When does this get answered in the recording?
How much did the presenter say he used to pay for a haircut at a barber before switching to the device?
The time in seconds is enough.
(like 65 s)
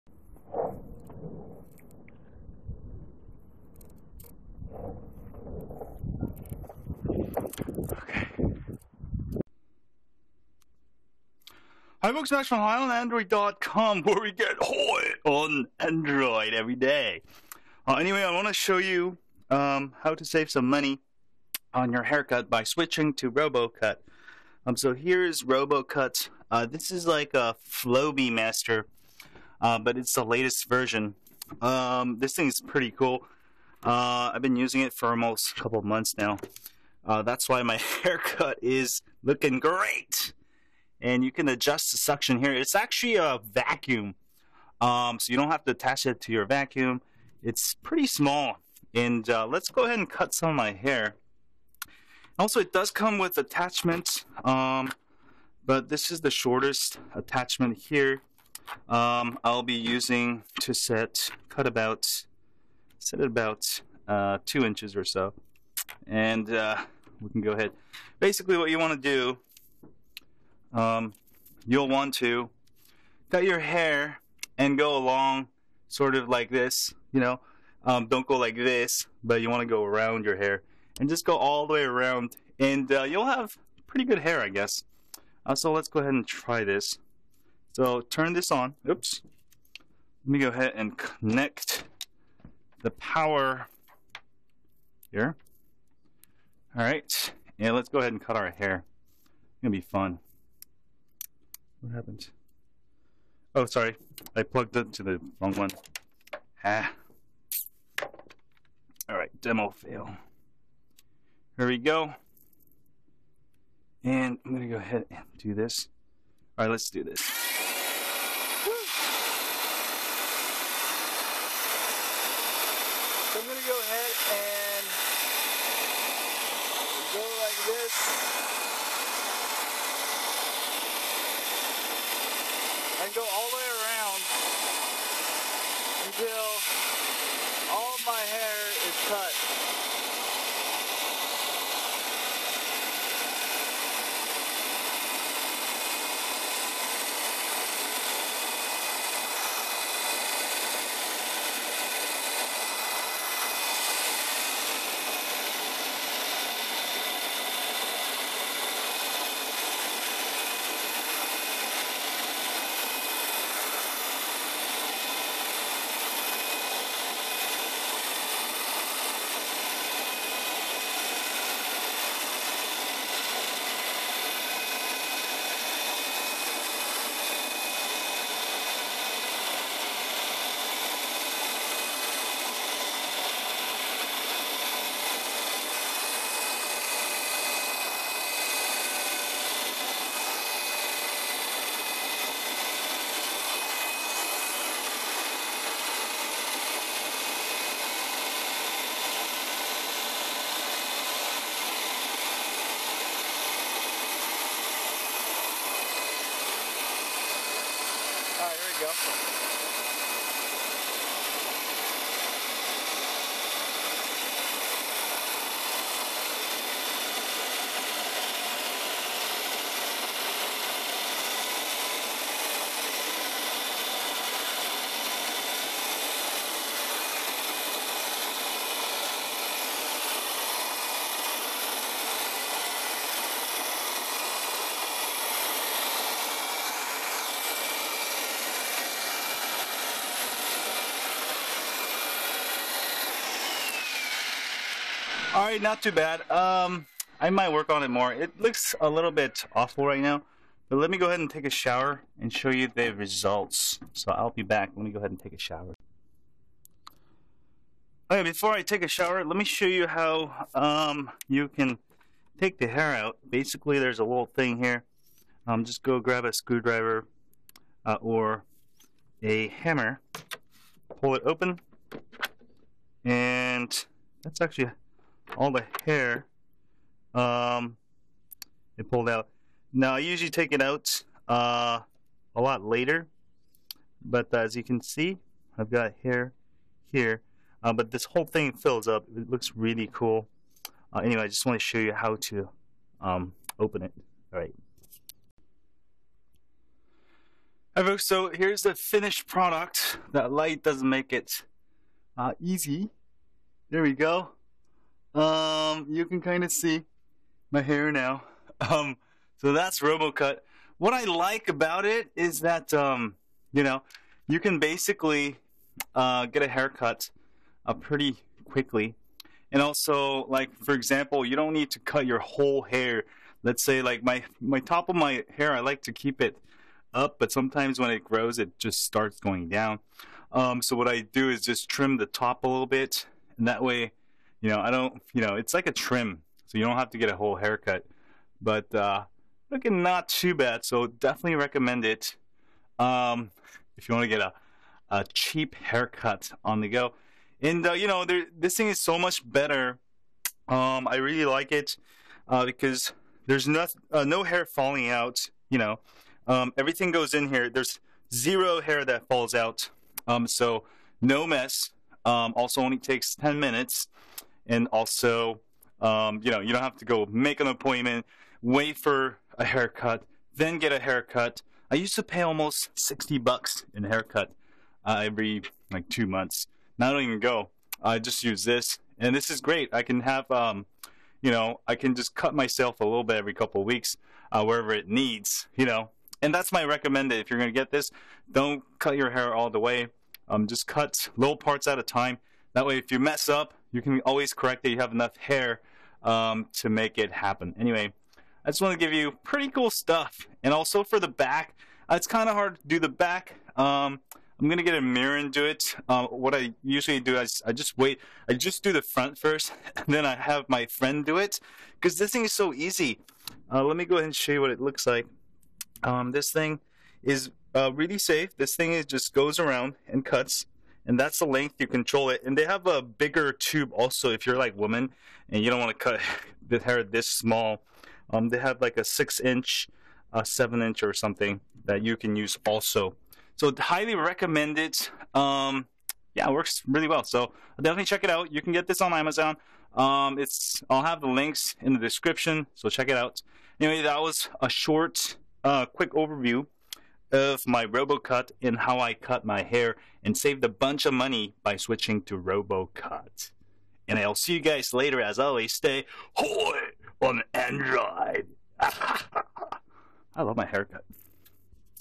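372 s.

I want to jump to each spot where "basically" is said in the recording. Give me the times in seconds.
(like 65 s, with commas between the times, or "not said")
68 s, 263 s, 314 s.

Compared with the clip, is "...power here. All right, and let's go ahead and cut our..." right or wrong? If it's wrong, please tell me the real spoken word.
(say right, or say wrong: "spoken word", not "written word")
right.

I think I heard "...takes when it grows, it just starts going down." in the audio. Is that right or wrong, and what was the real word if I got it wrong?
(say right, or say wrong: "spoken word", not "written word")
wrong: "sometimes", not "takes".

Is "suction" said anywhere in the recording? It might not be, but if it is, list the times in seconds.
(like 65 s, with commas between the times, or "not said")
41 s.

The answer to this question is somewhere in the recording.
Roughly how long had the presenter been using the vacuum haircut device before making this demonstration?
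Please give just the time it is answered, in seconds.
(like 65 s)
35 s.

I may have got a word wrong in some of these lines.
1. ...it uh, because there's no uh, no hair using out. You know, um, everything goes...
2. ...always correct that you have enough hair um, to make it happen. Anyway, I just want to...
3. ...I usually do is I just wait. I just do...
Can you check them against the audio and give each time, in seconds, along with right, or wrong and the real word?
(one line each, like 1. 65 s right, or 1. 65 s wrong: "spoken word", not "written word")
1. 351 s wrong: "falling", not "using"
2. 394 s right
3. 406 s right.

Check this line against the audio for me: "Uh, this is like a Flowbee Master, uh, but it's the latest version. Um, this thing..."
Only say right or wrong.
right.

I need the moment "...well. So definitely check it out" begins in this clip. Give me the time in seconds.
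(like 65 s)
436 s.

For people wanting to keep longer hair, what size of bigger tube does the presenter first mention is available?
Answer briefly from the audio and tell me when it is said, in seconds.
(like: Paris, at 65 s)
6 inch, at 428 s.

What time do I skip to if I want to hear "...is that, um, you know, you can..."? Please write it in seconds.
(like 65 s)
312 s.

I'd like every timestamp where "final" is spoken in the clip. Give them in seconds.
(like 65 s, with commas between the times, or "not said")
not said.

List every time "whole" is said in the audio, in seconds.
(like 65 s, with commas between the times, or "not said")
288 s, 322 s, 337 s.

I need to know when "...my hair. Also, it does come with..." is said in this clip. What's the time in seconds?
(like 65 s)
50 s.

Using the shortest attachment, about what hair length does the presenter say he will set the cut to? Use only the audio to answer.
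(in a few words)
2 inches.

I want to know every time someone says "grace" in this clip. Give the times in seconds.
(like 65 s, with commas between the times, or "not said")
not said.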